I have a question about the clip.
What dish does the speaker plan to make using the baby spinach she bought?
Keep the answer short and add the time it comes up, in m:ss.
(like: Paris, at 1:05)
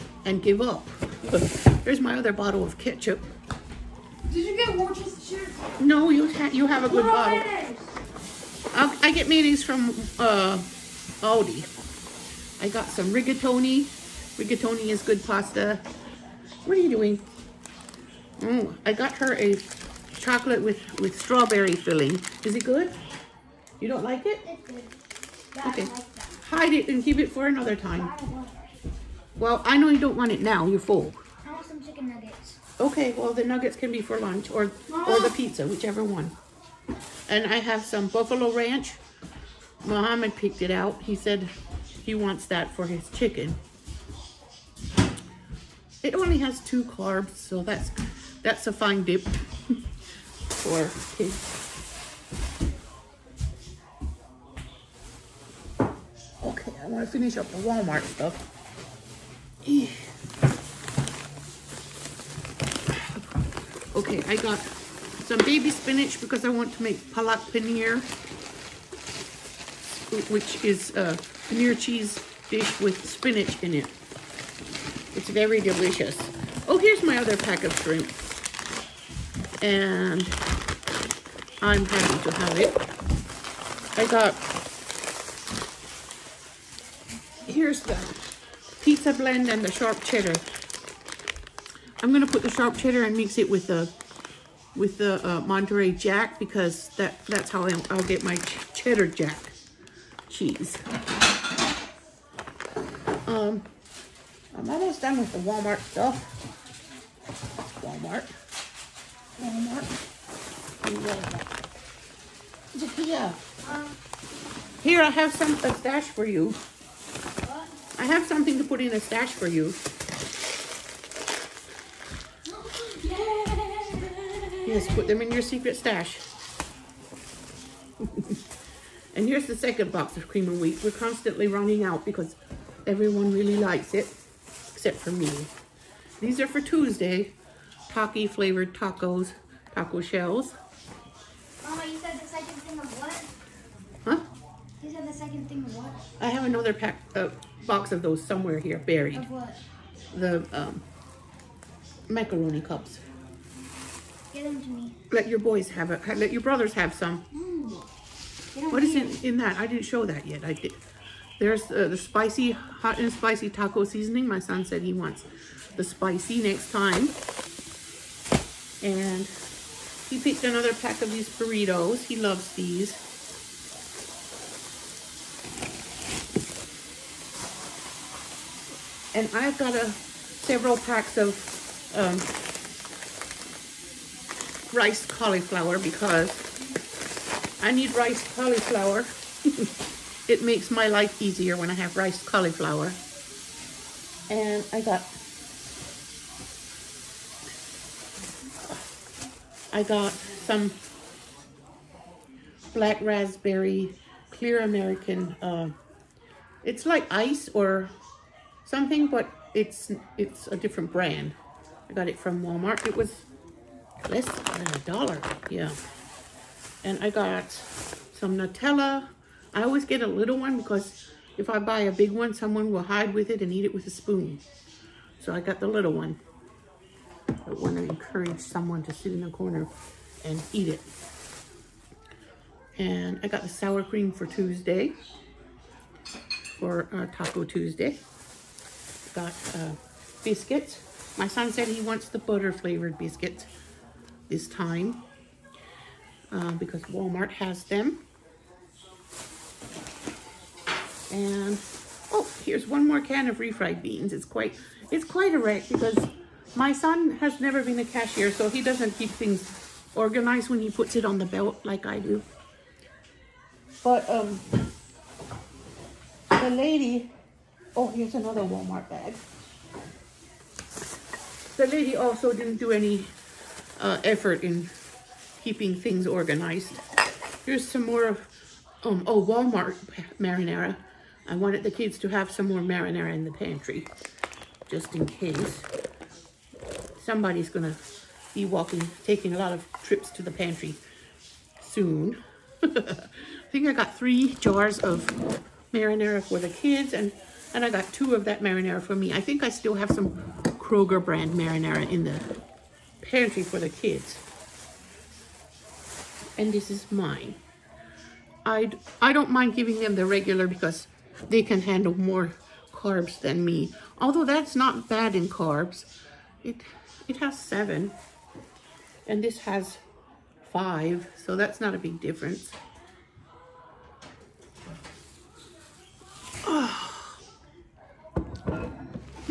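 palak paneer, at 1:07.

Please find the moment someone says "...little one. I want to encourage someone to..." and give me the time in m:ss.
3:45.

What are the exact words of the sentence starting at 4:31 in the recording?
The lady also didn't do any uh, effort in keeping things organized.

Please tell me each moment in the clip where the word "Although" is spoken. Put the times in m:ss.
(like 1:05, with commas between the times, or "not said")
5:14.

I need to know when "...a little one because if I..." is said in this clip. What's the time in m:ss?
3:40.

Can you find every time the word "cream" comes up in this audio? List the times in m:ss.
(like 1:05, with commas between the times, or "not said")
2:10, 3:53.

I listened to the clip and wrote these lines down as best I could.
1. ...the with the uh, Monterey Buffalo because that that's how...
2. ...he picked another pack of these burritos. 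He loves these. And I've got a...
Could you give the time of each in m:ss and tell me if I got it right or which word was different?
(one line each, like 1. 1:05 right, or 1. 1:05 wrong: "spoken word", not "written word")
1. 1:33 wrong: "Jack", not "Buffalo"
2. 2:50 right.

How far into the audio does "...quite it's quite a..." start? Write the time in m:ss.
4:14.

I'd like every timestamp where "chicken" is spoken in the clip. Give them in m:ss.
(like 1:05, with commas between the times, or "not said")
0:31, 0:43.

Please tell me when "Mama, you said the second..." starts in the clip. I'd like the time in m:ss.
2:21.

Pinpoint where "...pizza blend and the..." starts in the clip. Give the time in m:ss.
1:28.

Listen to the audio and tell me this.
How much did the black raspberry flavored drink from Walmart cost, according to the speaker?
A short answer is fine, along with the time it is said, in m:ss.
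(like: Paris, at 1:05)
less than a dollar, at 3:34.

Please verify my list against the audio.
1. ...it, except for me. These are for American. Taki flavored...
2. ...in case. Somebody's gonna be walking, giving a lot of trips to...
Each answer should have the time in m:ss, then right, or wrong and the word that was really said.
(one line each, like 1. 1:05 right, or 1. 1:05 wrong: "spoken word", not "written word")
1. 2:13 wrong: "Tuesday", not "American"
2. 4:44 wrong: "taking", not "giving".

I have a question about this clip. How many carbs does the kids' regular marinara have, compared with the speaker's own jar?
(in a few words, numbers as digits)
7.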